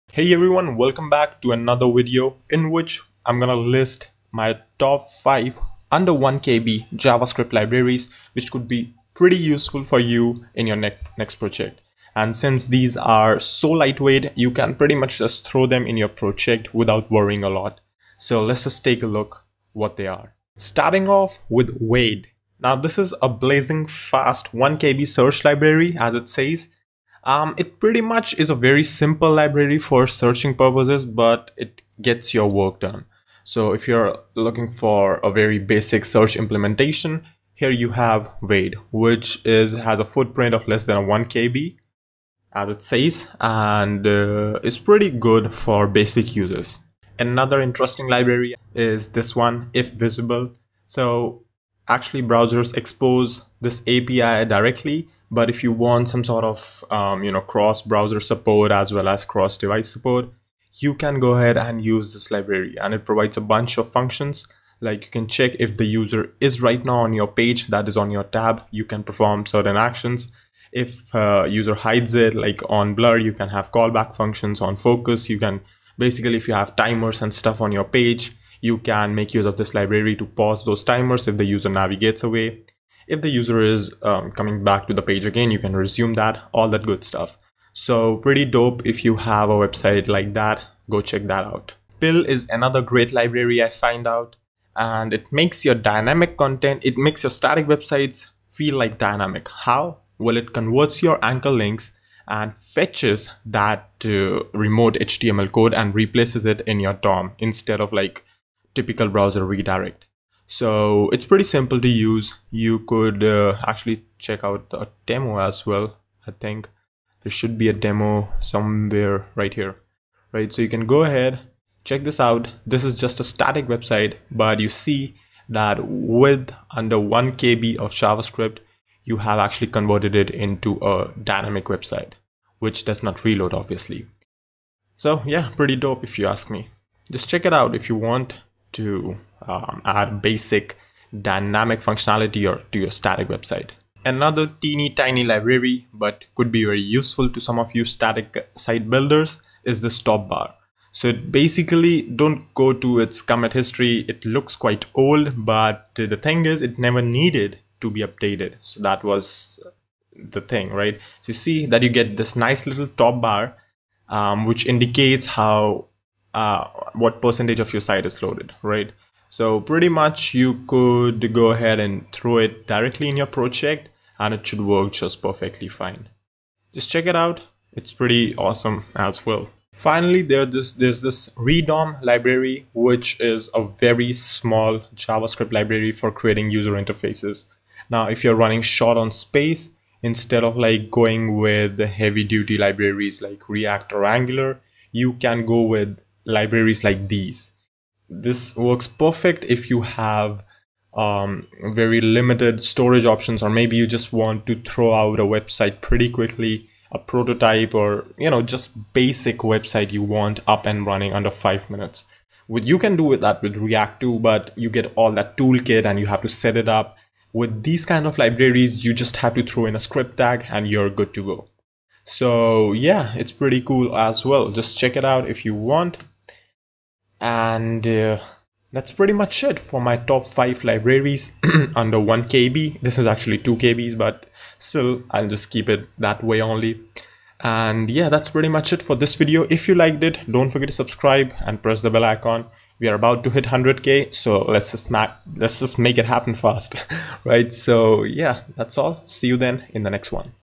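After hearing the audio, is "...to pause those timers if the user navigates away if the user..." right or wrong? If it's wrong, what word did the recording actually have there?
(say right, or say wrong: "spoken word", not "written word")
right.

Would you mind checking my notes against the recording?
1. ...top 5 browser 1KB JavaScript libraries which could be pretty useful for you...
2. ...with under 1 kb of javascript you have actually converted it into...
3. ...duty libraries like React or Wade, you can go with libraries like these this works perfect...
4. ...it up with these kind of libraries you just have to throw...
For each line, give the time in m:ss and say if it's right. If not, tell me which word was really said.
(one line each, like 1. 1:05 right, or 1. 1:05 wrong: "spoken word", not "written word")
1. 0:04 wrong: "under", not "browser"
2. 2:05 right
3. 3:12 wrong: "Angular", not "Wade"
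4. 3:36 right.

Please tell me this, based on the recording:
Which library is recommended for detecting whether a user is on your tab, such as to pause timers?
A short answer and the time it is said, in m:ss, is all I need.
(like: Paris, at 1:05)
ifvisible, at 0:49.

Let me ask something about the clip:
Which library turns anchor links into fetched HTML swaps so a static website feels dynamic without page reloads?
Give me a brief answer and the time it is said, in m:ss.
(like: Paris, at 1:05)
Pill, at 1:31.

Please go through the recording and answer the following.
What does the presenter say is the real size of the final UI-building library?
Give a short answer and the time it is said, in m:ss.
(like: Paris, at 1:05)
2KB, at 3:53.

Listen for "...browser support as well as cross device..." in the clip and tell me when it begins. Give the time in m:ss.
0:57.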